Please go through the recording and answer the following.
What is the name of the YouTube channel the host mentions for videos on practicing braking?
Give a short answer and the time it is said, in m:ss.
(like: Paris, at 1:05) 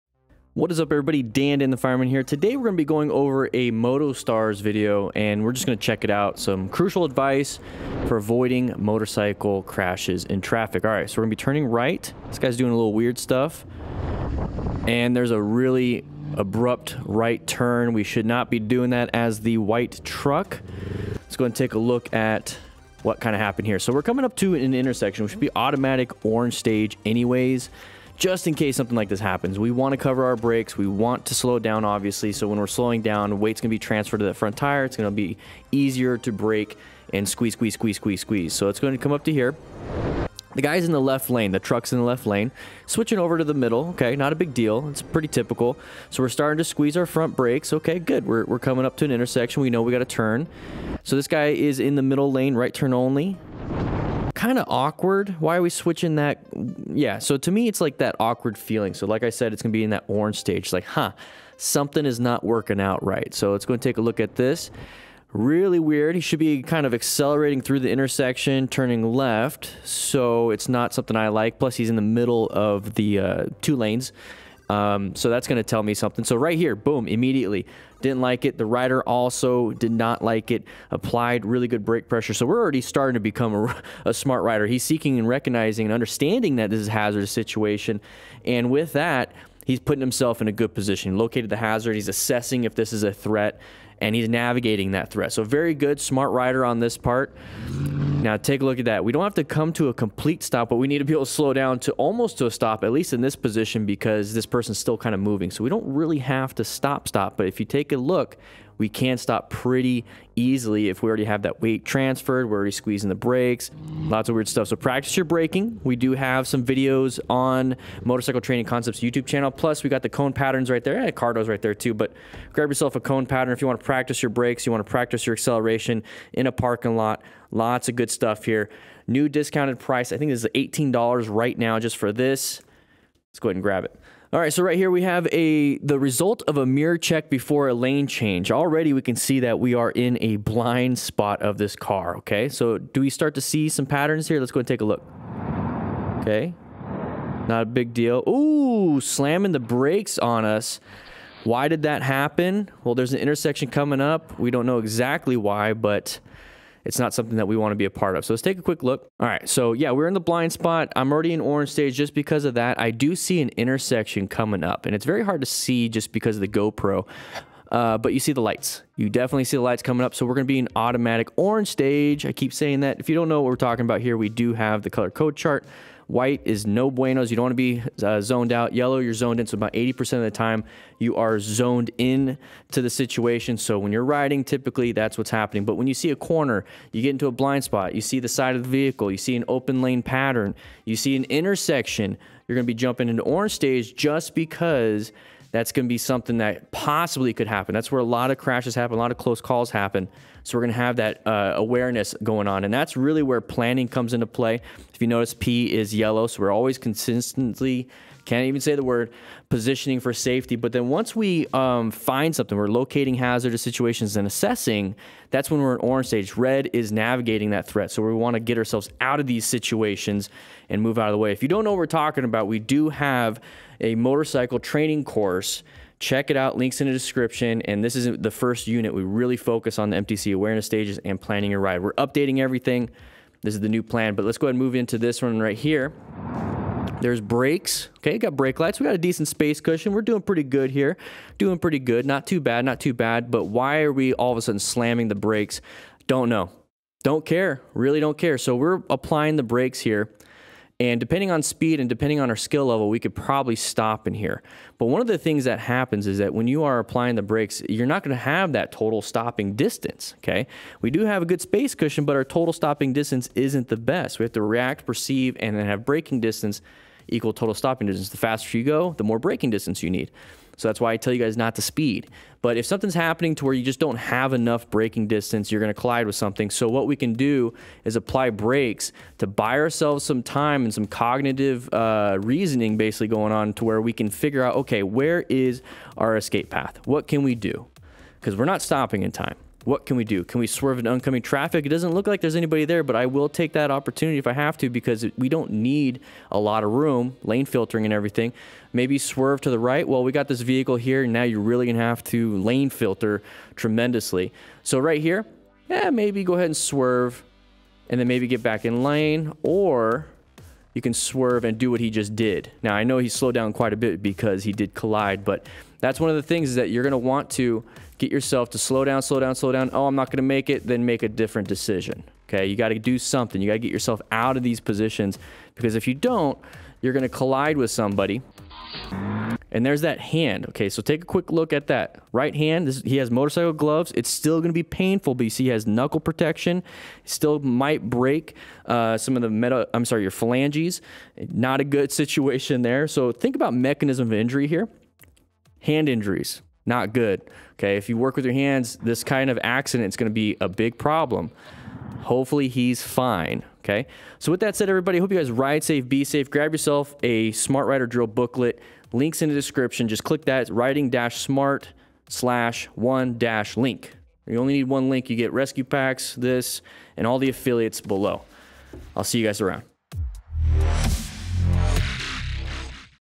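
Motorcycle Training Concepts, at 1:58.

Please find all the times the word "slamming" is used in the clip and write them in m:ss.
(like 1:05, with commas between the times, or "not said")
2:29, 4:04.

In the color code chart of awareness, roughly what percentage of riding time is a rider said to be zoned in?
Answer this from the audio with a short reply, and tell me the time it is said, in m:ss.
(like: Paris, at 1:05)
80%, at 2:59.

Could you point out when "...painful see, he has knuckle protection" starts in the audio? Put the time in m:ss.
5:34.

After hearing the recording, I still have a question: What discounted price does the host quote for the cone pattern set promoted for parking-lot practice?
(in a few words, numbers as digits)
$18.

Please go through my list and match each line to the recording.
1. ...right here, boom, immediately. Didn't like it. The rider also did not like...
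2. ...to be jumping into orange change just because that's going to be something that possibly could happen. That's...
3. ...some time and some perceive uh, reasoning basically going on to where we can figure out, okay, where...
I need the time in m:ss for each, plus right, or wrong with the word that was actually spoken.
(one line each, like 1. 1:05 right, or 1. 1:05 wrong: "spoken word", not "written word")
1. 1:16 right
2. 3:12 wrong: "stage", not "change"
3. 4:40 wrong: "cognitive", not "perceive".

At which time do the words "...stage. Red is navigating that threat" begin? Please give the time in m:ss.
3:36.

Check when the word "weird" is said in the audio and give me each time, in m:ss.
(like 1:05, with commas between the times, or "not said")
0:12, 1:05, 1:54.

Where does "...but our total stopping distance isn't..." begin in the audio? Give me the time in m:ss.
4:22.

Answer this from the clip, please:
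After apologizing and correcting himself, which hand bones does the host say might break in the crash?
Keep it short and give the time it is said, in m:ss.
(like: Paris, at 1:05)
phalanges, at 5:40.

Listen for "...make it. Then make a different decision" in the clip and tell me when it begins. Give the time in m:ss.
5:20.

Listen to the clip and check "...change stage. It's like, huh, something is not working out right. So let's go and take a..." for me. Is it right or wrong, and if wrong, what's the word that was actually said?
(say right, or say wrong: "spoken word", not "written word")
wrong: "orange", not "change".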